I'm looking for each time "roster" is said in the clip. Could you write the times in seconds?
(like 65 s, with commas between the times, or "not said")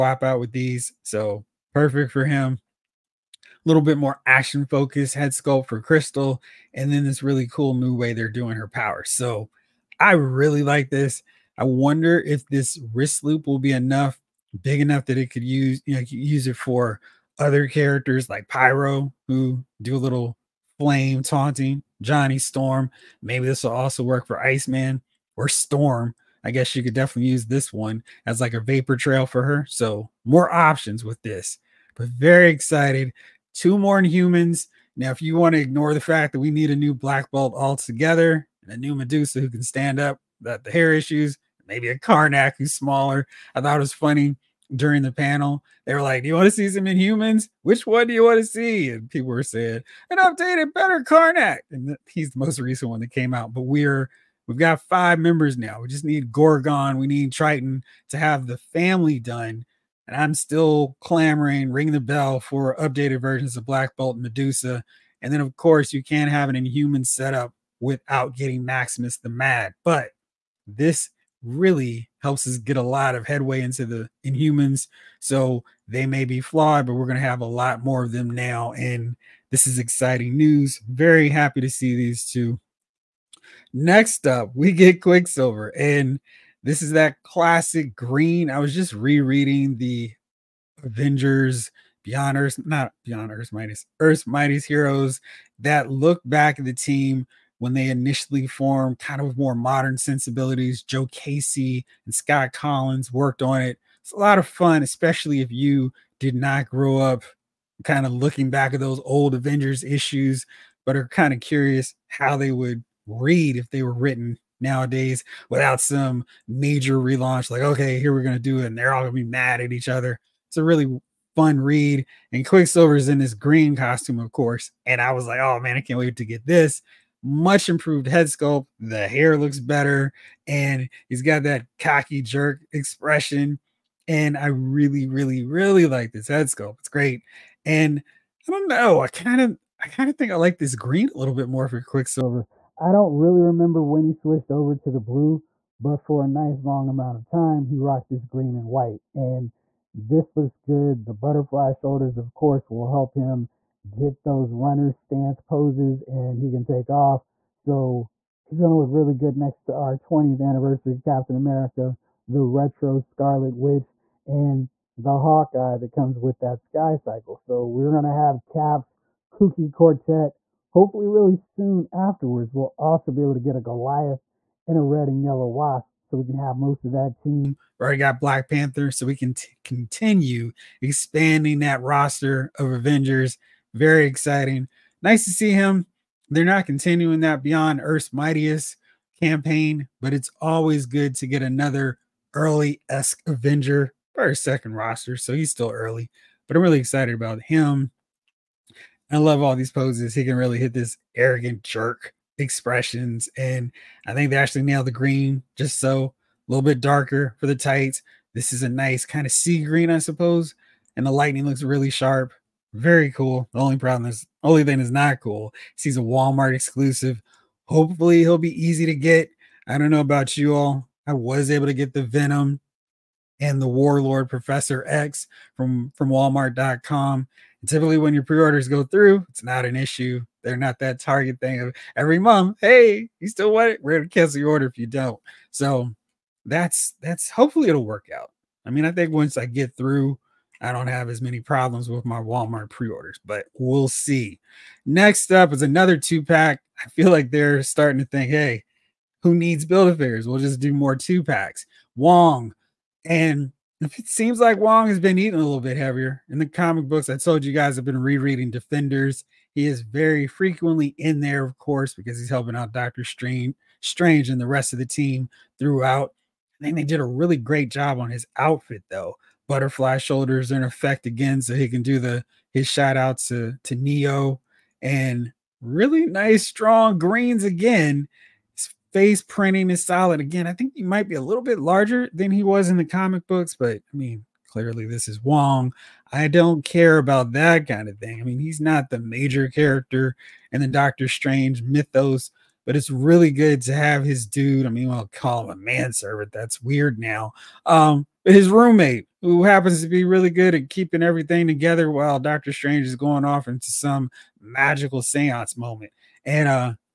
181 s, 194 s.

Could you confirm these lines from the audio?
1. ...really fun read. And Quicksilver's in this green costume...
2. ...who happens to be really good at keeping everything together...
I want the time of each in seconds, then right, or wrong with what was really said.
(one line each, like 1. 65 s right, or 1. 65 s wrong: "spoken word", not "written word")
1. 120 s right
2. 299 s right.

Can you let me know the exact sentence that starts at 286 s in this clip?
I don't care about that kind of thing.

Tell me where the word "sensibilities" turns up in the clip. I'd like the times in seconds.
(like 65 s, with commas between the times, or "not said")
99 s.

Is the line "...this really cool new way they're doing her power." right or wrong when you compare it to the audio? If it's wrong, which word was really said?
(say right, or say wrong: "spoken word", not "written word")
right.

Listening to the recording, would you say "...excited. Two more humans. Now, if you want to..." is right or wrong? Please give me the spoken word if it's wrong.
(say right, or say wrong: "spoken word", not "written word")
right.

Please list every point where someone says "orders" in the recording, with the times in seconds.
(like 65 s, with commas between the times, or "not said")
228 s, 234 s, 242 s.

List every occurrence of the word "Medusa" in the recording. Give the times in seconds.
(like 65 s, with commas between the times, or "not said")
38 s, 64 s.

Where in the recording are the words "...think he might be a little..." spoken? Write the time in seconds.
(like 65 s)
280 s.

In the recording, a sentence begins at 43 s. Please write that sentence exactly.
I thought it was funny during the panel.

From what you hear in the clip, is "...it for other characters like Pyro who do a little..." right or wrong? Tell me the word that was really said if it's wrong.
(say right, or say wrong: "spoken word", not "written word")
right.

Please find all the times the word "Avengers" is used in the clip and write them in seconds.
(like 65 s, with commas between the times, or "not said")
90 s, 109 s, 182 s, 193 s.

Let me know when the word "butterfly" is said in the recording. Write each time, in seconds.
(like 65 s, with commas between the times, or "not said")
151 s, 269 s.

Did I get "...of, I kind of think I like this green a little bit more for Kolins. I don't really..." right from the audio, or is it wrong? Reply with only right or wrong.
wrong.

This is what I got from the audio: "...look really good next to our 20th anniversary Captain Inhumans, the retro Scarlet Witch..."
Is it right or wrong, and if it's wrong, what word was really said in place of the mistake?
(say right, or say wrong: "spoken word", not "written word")
wrong: "America", not "Inhumans".